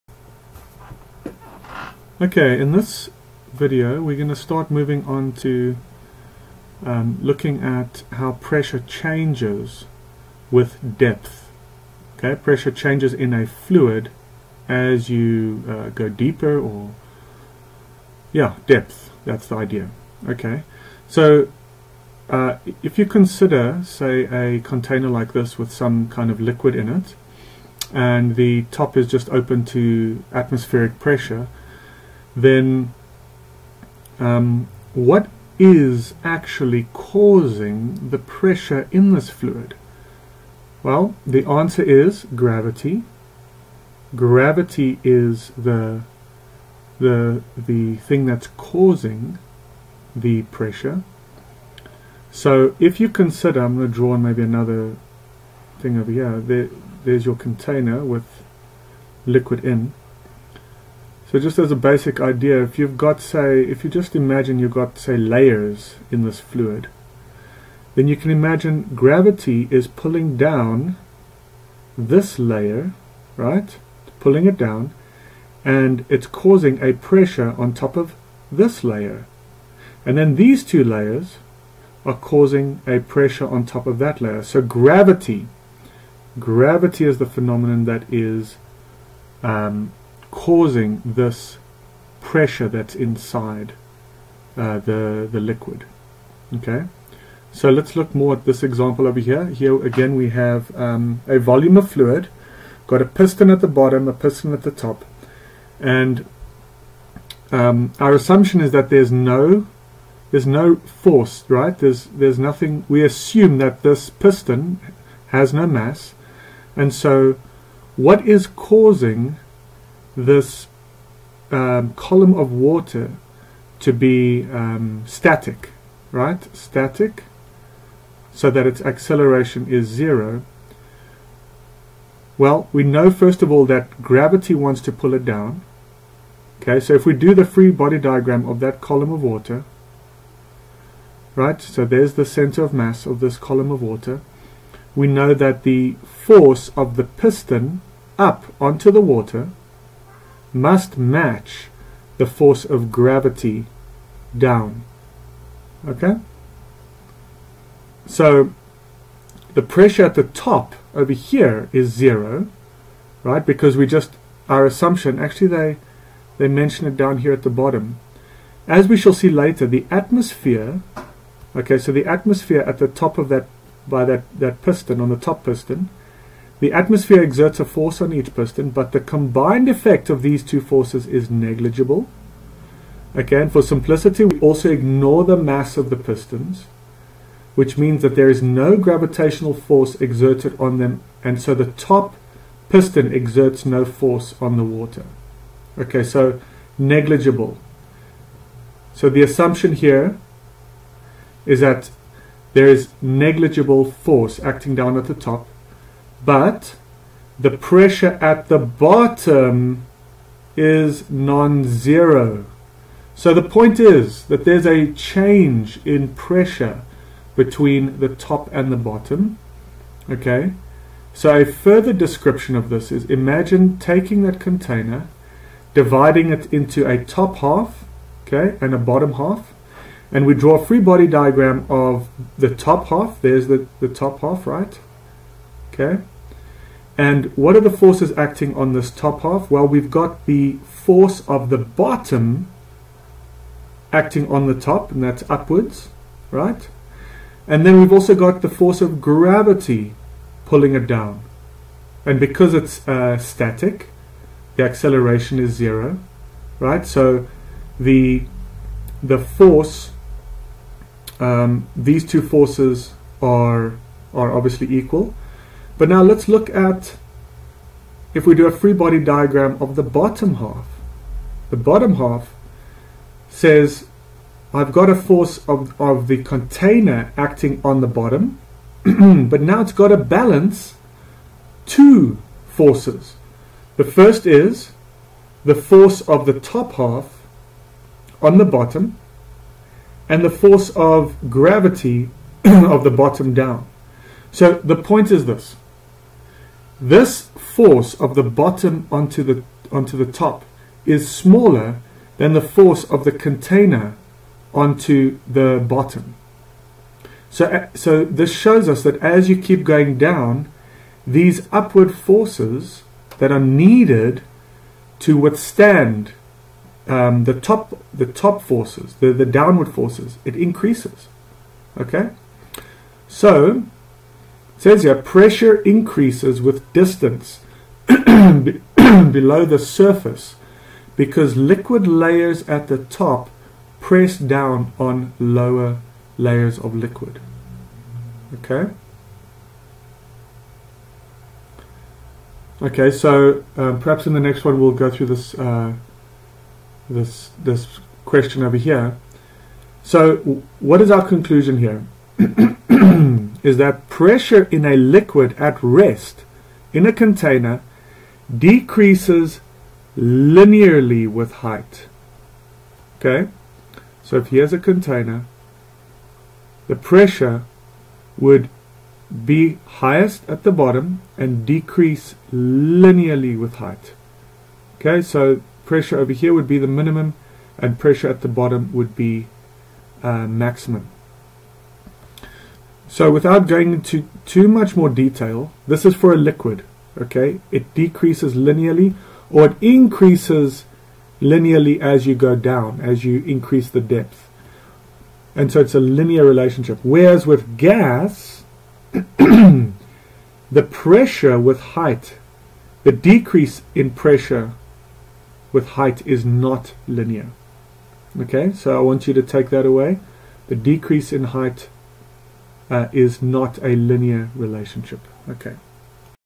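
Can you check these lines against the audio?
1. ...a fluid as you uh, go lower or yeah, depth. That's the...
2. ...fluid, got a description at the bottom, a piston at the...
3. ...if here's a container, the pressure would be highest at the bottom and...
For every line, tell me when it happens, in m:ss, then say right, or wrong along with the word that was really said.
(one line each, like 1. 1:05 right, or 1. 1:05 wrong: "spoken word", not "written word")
1. 0:13 wrong: "deeper", not "lower"
2. 1:41 wrong: "piston", not "description"
3. 6:04 right.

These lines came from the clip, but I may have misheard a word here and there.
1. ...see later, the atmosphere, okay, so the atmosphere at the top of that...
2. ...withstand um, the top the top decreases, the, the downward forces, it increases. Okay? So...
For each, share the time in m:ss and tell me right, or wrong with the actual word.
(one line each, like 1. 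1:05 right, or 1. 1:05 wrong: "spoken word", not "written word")
1. 2:49 right
2. 5:15 wrong: "forces", not "decreases".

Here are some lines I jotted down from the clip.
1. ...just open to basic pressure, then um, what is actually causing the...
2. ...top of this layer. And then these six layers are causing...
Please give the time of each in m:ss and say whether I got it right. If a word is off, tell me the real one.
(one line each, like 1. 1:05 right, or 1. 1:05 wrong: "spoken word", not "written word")
1. 0:29 wrong: "atmospheric", not "basic"
2. 1:17 wrong: "two", not "six".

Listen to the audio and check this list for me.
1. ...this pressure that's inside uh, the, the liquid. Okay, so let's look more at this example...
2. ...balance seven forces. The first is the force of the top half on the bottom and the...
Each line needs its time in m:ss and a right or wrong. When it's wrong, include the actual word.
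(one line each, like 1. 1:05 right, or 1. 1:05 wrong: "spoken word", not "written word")
1. 1:31 right
2. 4:39 wrong: "two", not "seven".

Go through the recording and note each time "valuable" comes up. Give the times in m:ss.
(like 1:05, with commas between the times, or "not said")
not said.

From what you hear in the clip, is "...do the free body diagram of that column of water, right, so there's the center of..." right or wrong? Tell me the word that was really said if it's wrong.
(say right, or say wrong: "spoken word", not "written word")
right.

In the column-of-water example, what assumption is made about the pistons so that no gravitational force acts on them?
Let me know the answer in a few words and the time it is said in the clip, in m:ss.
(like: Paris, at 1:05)
No mass, at 1:53.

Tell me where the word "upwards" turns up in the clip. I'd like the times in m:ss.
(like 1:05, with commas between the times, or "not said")
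4:05, 5:11.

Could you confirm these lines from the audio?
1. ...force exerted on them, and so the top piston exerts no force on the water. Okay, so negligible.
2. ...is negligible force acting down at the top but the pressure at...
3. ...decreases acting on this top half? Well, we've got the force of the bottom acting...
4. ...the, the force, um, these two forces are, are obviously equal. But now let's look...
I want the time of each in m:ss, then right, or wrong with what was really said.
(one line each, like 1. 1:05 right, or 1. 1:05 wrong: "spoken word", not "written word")
1. 3:09 right
2. 3:22 right
3. 3:57 wrong: "forces", not "decreases"
4. 4:17 right.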